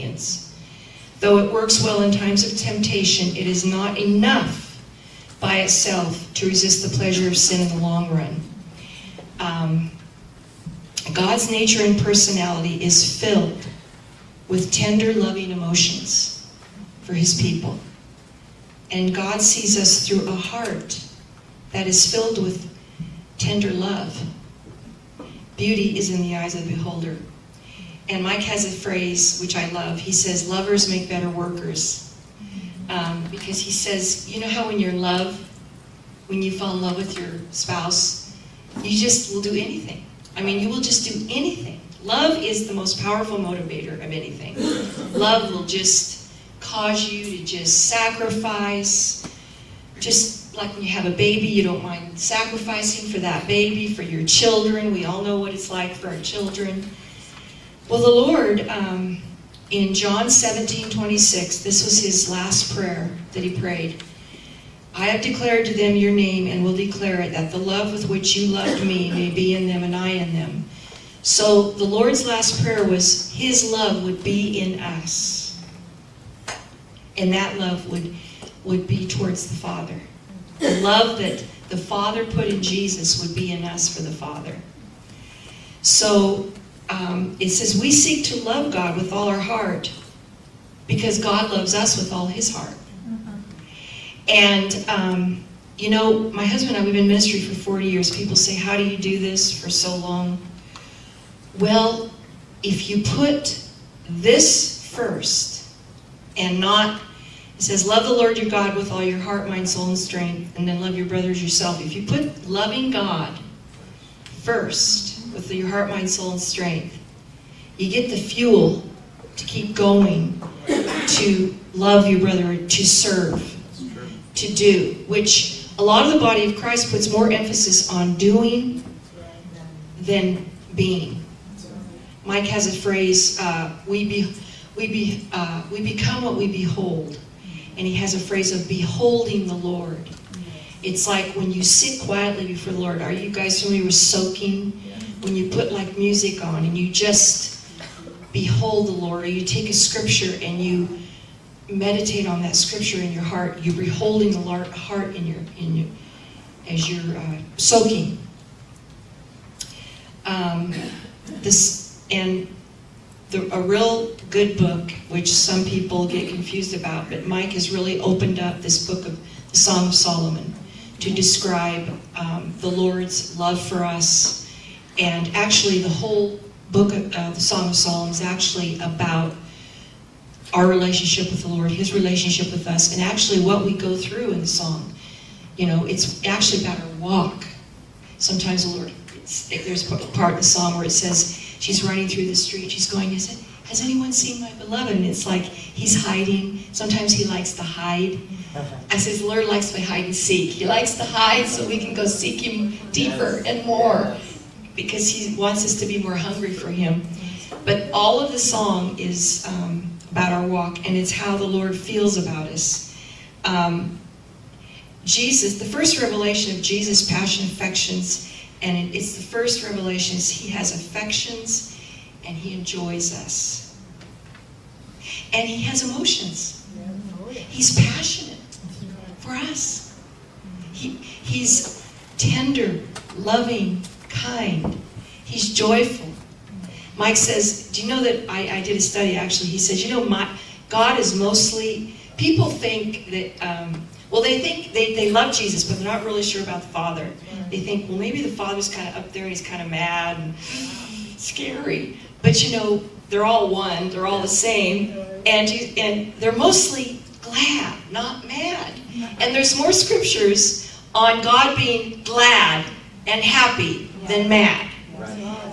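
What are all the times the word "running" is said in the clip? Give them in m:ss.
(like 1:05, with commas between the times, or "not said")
3:11.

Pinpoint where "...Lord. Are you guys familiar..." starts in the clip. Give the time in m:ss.
2:22.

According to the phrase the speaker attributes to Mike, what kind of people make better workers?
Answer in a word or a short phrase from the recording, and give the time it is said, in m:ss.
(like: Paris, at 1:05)
Lovers, at 0:30.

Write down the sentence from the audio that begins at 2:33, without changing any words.
You're beholding the Lord, heart in your in your, as you're uh, soaking.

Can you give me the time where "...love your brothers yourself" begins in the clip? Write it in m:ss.
1:50.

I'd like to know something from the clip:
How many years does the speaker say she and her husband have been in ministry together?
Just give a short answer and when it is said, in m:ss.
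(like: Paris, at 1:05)
40, at 1:37.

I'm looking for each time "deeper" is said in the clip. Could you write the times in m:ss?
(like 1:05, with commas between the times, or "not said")
3:22.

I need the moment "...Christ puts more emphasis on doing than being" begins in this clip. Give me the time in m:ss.
2:06.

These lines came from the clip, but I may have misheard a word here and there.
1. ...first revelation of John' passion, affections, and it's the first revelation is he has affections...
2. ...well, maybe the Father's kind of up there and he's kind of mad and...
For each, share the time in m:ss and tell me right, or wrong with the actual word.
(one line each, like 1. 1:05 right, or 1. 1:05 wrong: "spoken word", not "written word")
1. 3:35 wrong: "Jesus", not "John"
2. 4:07 right.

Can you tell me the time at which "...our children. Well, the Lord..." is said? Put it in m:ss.
0:56.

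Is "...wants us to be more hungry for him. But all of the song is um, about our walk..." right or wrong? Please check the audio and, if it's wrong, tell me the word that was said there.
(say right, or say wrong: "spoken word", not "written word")
right.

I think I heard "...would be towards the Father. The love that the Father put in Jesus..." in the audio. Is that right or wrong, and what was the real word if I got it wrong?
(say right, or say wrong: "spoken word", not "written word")
right.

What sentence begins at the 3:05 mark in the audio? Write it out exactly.
You know, it's actually about our walk.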